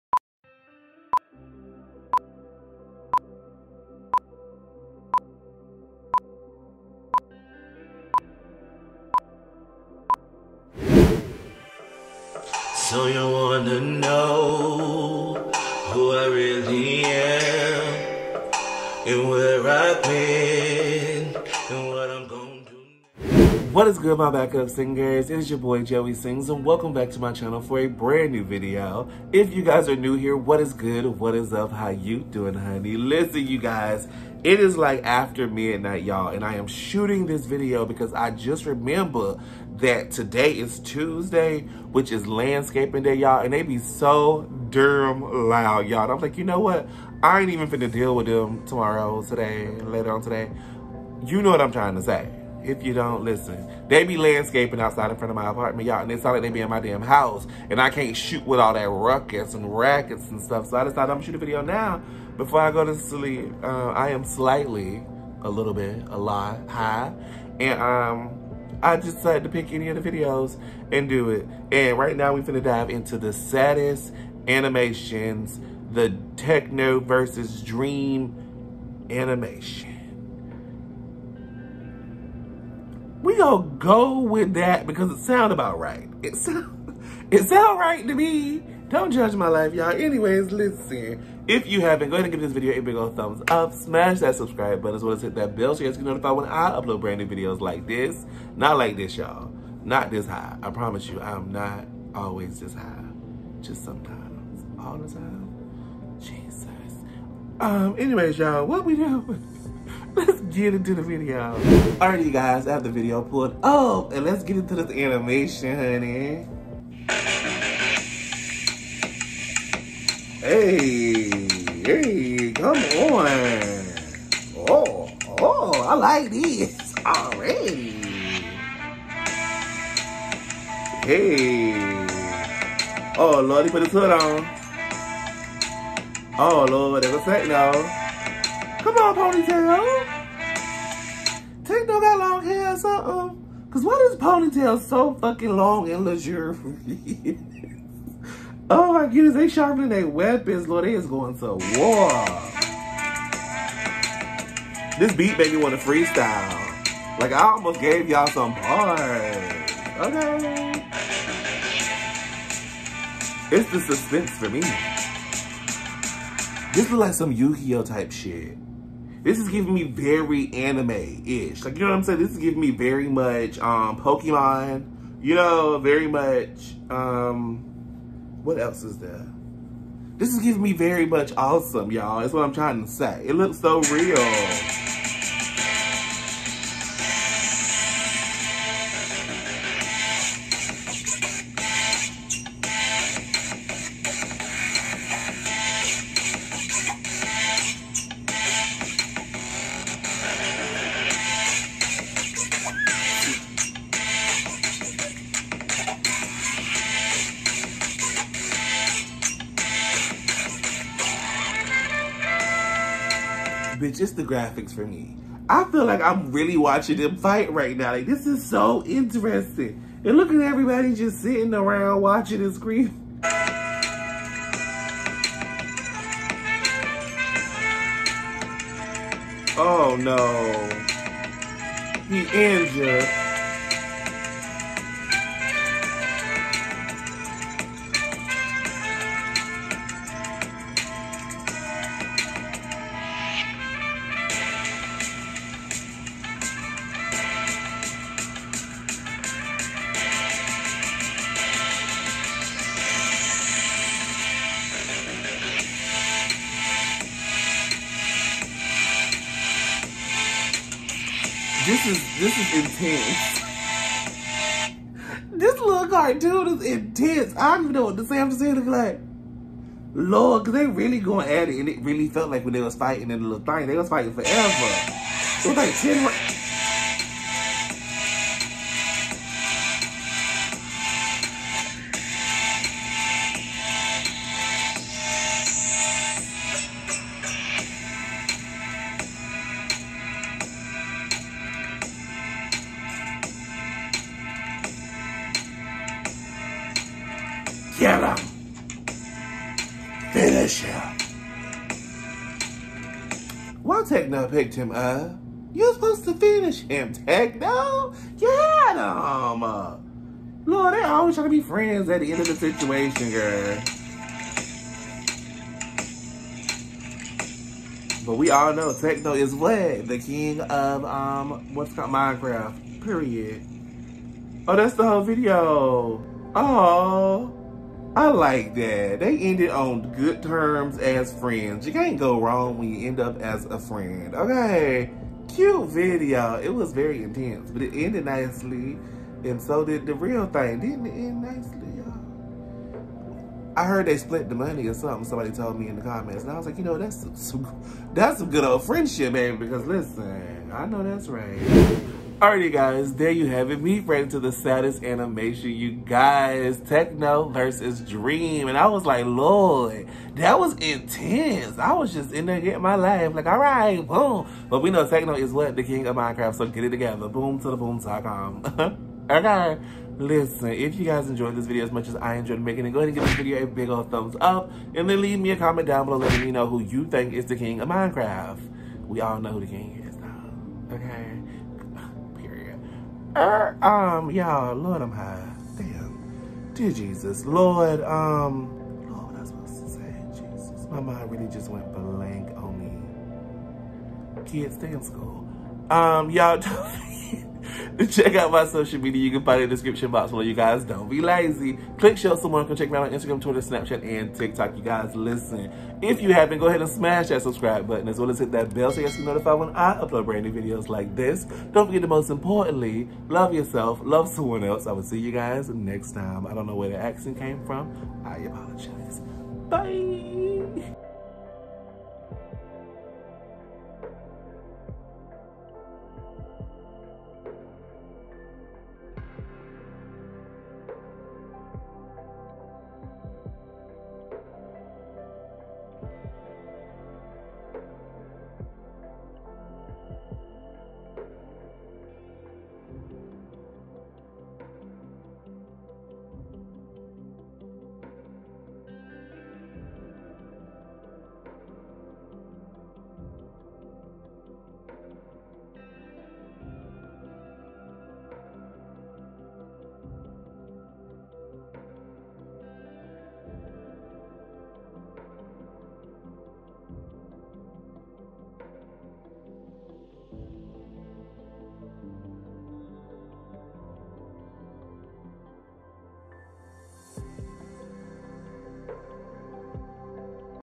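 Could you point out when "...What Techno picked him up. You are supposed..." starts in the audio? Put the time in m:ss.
5:03.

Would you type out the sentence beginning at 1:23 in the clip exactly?
gonna go with that because it sound about right.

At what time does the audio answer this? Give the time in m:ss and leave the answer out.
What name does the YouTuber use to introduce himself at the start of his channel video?
0:25.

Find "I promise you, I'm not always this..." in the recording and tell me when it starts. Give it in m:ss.
1:40.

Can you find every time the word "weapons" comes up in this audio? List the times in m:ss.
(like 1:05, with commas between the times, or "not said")
2:30.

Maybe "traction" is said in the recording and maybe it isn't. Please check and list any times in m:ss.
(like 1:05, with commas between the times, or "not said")
not said.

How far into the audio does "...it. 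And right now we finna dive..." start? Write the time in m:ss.
1:11.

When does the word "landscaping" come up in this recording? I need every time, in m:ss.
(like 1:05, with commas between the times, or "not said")
0:42, 0:54.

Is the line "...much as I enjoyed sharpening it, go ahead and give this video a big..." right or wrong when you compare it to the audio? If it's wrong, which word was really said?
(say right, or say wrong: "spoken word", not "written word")
wrong: "making", not "sharpening".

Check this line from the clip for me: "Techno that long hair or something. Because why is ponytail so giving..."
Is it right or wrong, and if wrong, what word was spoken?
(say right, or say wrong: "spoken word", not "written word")
wrong: "fucking", not "giving".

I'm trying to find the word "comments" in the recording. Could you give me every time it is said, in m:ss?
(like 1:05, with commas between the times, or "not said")
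5:45, 6:15.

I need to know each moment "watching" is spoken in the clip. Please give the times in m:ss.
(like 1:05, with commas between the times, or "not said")
3:36, 3:42.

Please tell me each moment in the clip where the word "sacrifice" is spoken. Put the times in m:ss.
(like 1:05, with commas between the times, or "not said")
not said.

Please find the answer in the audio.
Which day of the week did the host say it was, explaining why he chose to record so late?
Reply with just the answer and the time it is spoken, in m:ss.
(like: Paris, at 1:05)
Tuesday, at 0:40.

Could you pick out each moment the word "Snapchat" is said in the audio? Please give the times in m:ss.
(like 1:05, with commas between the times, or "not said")
6:43.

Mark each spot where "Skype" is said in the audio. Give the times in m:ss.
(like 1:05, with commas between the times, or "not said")
not said.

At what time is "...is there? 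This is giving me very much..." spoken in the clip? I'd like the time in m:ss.
2:58.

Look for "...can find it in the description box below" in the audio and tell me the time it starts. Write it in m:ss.
6:39.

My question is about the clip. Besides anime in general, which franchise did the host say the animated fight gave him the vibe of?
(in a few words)
Pokemon.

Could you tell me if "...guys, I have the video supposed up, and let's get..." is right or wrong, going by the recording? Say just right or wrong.
wrong.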